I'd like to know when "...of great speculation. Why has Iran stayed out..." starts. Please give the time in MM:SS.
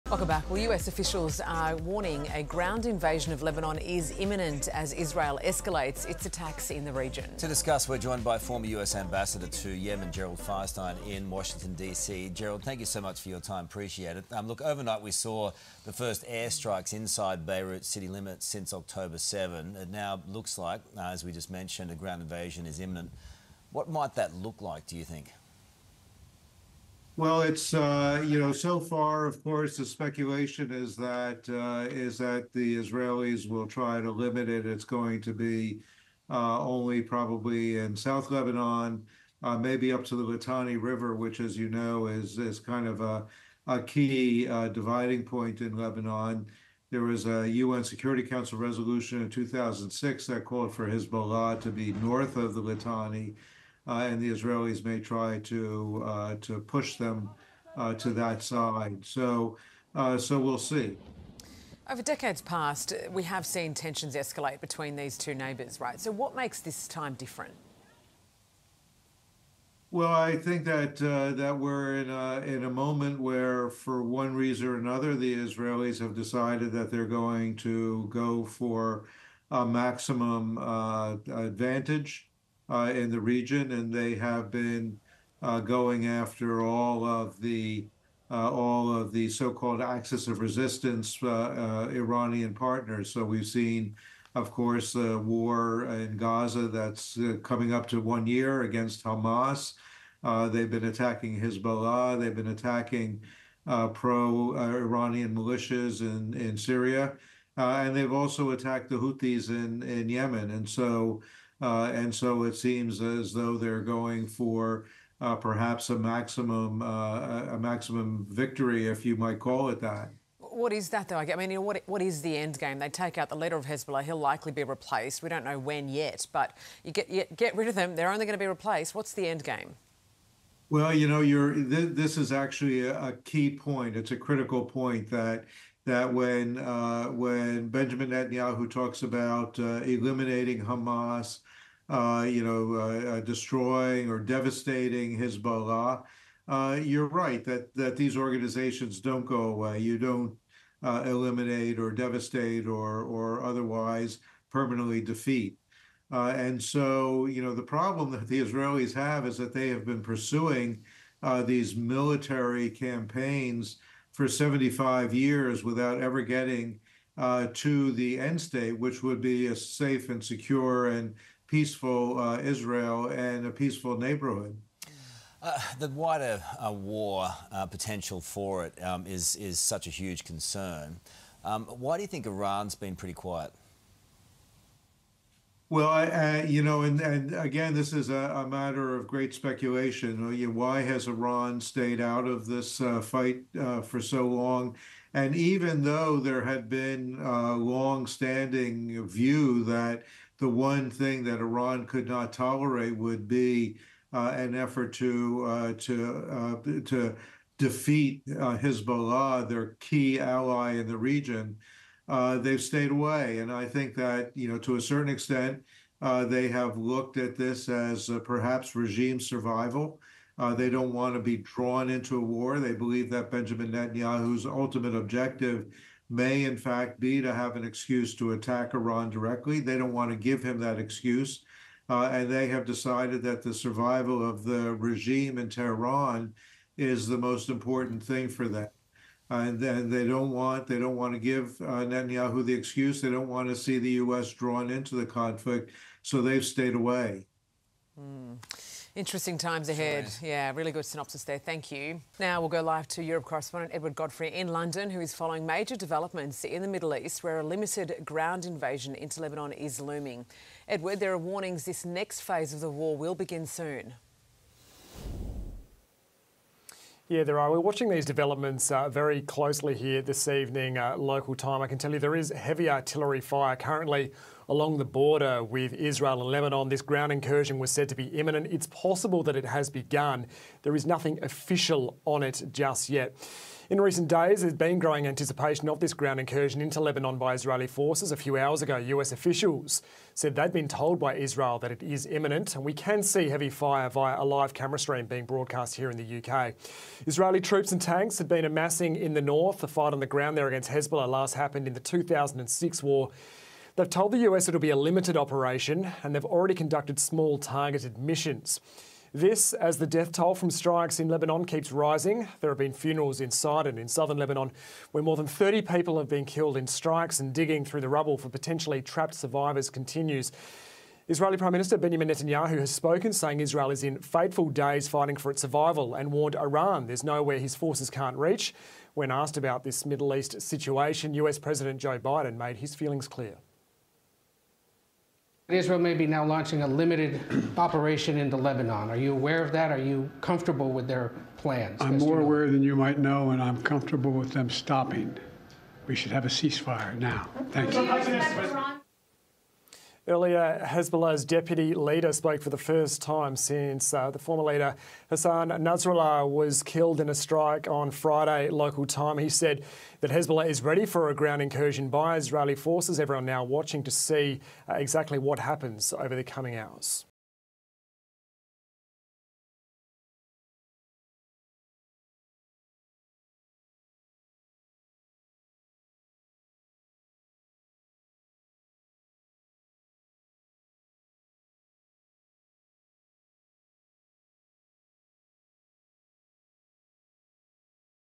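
03:08.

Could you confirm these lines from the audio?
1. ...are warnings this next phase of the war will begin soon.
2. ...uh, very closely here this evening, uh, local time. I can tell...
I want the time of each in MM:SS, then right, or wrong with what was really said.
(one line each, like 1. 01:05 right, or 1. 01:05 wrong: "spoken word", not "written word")
1. 04:21 right
2. 04:28 right.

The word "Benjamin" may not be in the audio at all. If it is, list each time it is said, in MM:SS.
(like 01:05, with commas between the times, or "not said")
02:17, 03:43, 05:21.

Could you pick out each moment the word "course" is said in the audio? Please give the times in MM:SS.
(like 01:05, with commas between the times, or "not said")
00:29, 01:34.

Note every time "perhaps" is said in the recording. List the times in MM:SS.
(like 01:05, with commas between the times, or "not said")
01:55, 03:38.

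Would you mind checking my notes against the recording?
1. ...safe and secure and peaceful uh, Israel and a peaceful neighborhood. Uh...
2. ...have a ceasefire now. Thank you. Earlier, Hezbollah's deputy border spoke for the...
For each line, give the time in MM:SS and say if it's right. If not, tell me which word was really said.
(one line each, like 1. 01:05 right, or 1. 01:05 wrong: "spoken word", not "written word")
1. 02:49 right
2. 05:46 wrong: "leader", not "border".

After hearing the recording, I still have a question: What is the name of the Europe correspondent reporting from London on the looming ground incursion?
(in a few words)
Edward Godfrey.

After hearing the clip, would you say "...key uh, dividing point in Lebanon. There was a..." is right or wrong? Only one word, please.
right.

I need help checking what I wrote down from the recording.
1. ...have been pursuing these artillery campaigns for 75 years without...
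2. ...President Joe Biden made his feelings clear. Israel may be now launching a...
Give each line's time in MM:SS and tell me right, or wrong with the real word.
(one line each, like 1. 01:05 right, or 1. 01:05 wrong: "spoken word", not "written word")
1. 02:39 wrong: "military", not "artillery"
2. 05:31 right.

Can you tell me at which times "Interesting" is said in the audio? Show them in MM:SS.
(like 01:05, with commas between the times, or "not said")
04:08.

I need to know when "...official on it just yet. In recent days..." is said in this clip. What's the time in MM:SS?
04:41.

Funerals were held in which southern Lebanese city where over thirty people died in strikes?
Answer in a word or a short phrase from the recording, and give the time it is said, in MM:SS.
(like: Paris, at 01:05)
Sidon, at 05:13.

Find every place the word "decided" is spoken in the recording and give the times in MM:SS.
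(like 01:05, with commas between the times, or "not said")
01:16, 03:52.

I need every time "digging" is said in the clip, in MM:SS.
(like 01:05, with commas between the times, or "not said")
05:17.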